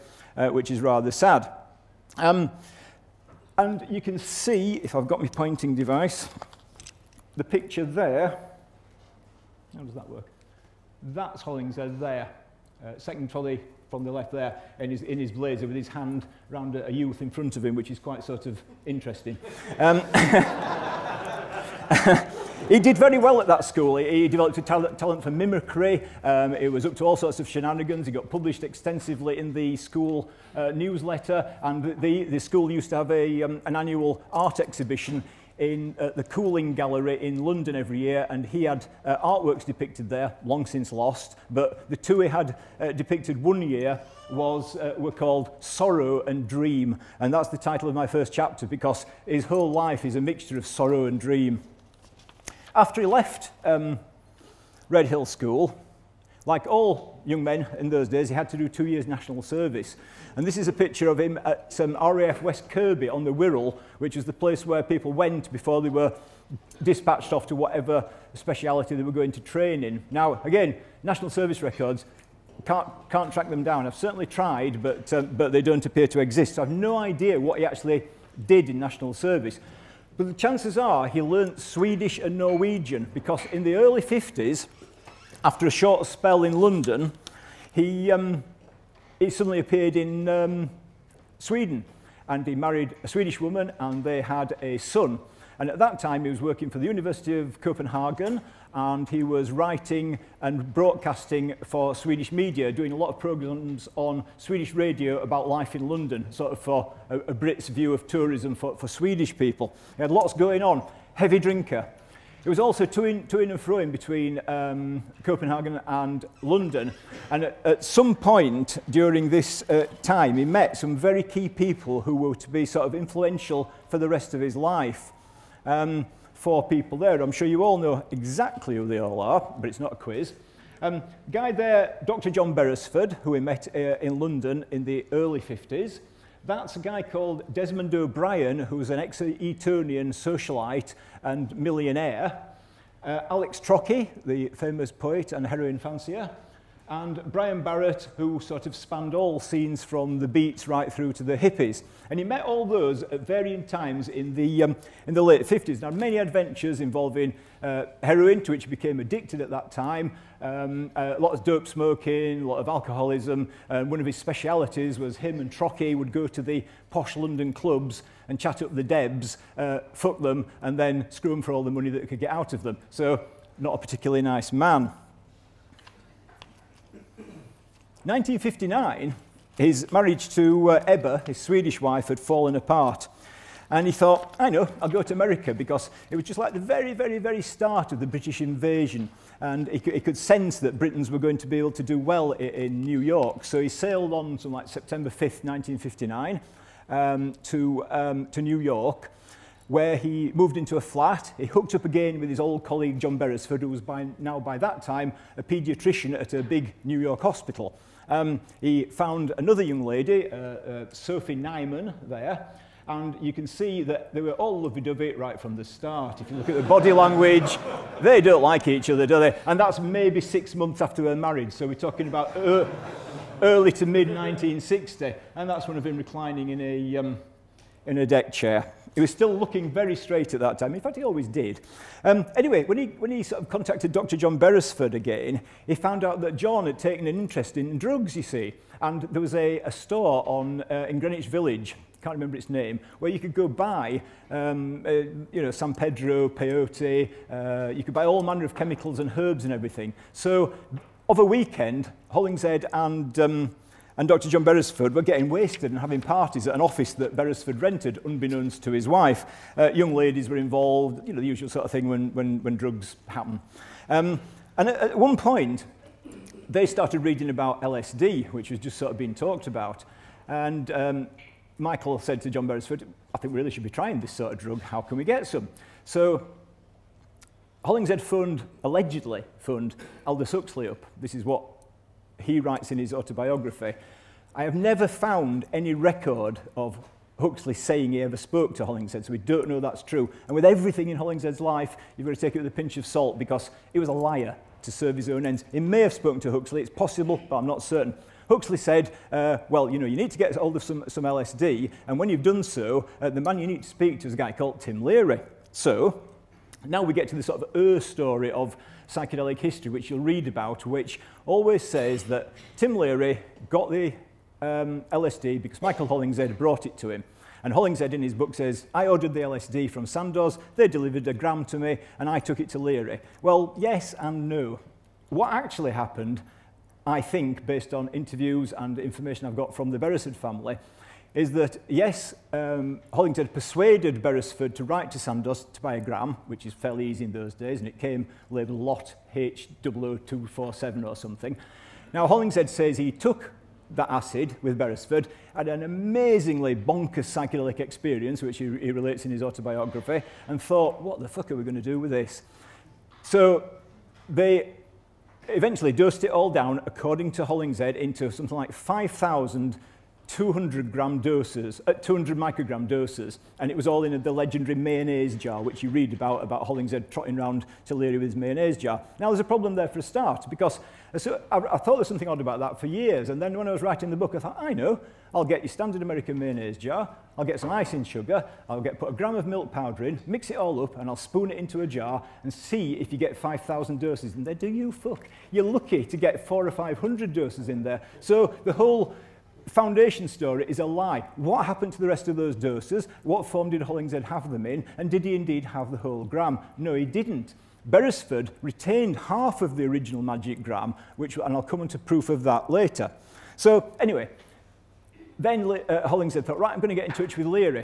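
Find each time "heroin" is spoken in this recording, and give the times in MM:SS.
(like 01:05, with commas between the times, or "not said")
02:25, 02:38.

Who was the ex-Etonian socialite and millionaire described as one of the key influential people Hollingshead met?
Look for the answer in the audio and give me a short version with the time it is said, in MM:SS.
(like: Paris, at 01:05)
Desmond O'Brien, at 02:17.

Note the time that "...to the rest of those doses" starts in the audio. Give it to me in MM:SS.
06:31.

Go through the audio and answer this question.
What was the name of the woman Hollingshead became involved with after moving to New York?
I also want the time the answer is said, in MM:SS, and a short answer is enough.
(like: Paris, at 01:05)
Sophie Nyman, at 03:30.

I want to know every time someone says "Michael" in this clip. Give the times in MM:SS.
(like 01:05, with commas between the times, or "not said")
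04:31, 05:15.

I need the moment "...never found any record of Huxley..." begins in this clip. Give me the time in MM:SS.
04:44.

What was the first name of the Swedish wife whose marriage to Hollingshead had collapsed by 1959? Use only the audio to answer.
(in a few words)
Ebba.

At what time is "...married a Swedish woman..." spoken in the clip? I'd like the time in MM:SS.
01:32.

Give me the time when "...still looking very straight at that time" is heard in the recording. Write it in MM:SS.
03:49.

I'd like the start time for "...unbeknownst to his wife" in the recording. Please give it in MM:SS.
04:18.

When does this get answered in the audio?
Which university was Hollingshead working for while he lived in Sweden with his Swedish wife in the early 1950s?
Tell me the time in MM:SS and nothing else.
01:36.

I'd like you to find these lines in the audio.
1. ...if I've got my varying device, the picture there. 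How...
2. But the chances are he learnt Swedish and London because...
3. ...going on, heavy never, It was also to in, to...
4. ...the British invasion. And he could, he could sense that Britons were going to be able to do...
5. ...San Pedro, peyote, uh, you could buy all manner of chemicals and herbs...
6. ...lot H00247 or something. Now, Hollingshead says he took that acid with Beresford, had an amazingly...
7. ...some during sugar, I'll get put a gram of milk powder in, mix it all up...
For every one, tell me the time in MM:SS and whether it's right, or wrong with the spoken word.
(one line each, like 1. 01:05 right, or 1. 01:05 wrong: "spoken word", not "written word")
1. 00:04 wrong: "pointing", not "varying"
2. 01:20 wrong: "Norwegian", not "London"
3. 01:50 wrong: "drinker", not "never"
4. 03:07 right
5. 04:05 right
6. 05:38 right
7. 06:17 wrong: "icing", not "during".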